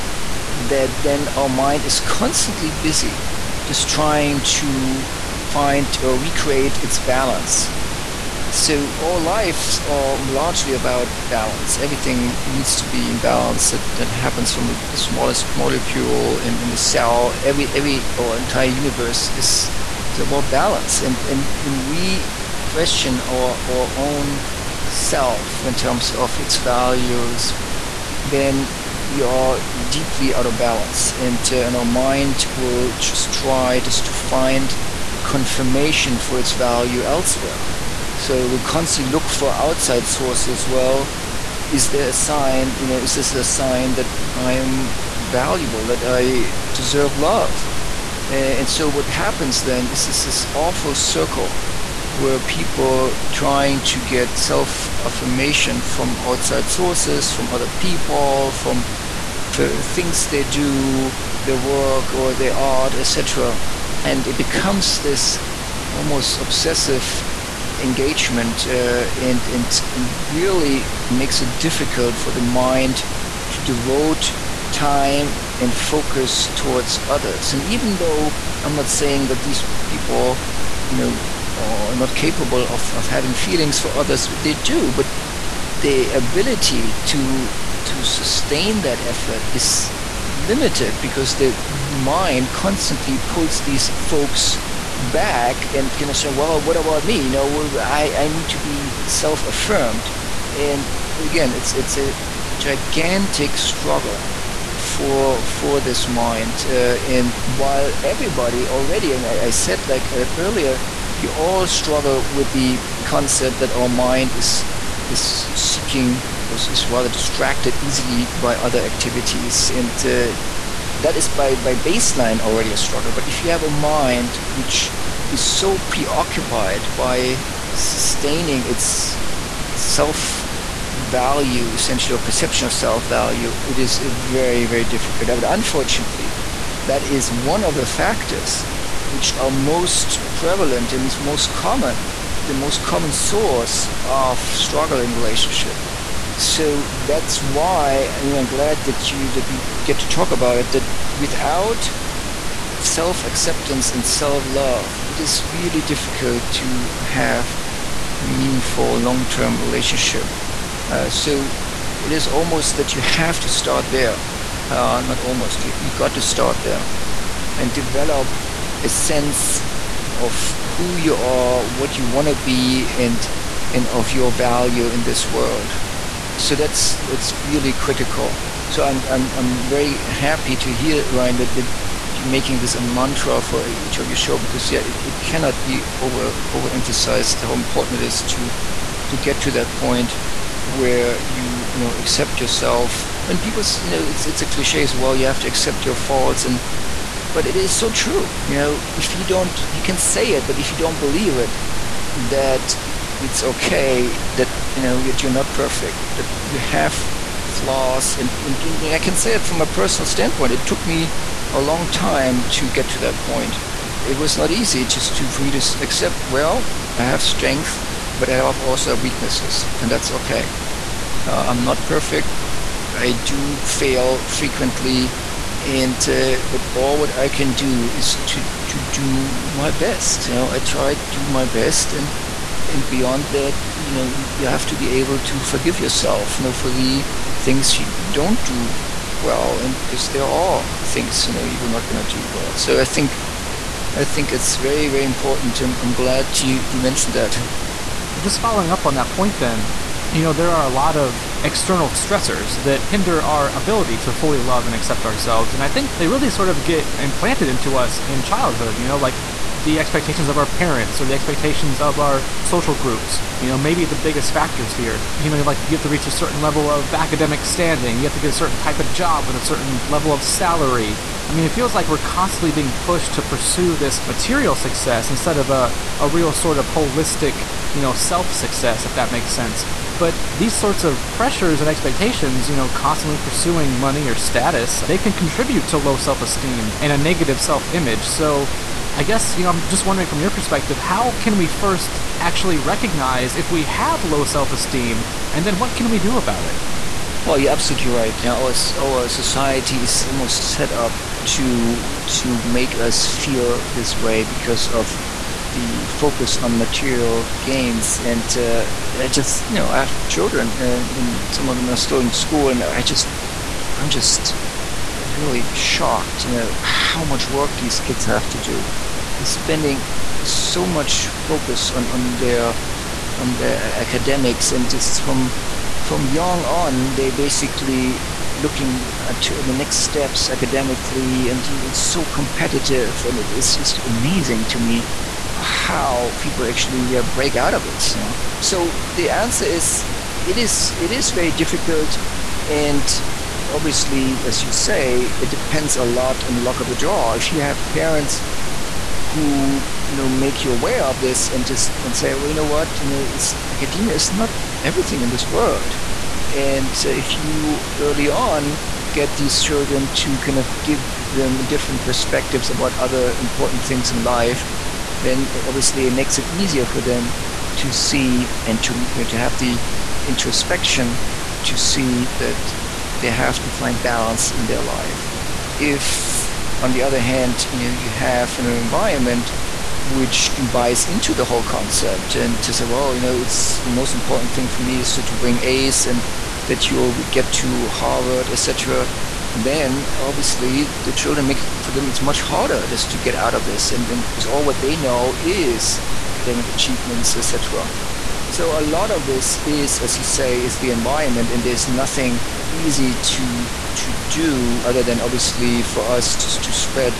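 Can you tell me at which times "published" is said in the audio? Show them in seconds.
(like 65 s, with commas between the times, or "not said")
not said.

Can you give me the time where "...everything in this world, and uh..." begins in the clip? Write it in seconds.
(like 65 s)
354 s.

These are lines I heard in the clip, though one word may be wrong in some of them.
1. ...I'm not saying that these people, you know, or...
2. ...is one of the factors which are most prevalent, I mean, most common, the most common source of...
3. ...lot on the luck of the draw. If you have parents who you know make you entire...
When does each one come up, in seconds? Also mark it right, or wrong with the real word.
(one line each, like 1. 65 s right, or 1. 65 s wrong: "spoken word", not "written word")
1. 78 s right
2. 137 s right
3. 345 s wrong: "aware", not "entire".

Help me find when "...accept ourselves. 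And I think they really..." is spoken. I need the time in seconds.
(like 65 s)
254 s.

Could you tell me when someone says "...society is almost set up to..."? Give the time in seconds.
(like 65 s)
299 s.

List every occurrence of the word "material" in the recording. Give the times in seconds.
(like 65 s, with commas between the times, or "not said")
274 s, 306 s.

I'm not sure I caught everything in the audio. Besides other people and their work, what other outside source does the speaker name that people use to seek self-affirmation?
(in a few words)
Their art.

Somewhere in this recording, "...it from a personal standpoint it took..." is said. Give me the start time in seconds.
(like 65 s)
209 s.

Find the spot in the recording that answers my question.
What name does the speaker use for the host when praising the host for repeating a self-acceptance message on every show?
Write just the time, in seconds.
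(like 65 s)
181 s.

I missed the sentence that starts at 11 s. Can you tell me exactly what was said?
Everything needs to be in balance that, that happens from the smallest molecule in, in the cell.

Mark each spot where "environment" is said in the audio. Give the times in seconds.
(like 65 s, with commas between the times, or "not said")
378 s, 400 s.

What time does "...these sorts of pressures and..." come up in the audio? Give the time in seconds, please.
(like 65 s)
280 s.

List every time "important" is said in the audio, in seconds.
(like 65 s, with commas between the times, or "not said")
187 s, 245 s, 363 s, 383 s.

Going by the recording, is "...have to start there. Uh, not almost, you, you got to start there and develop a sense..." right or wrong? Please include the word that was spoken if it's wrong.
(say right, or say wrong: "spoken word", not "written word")
right.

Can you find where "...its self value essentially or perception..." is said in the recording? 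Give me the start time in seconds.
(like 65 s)
128 s.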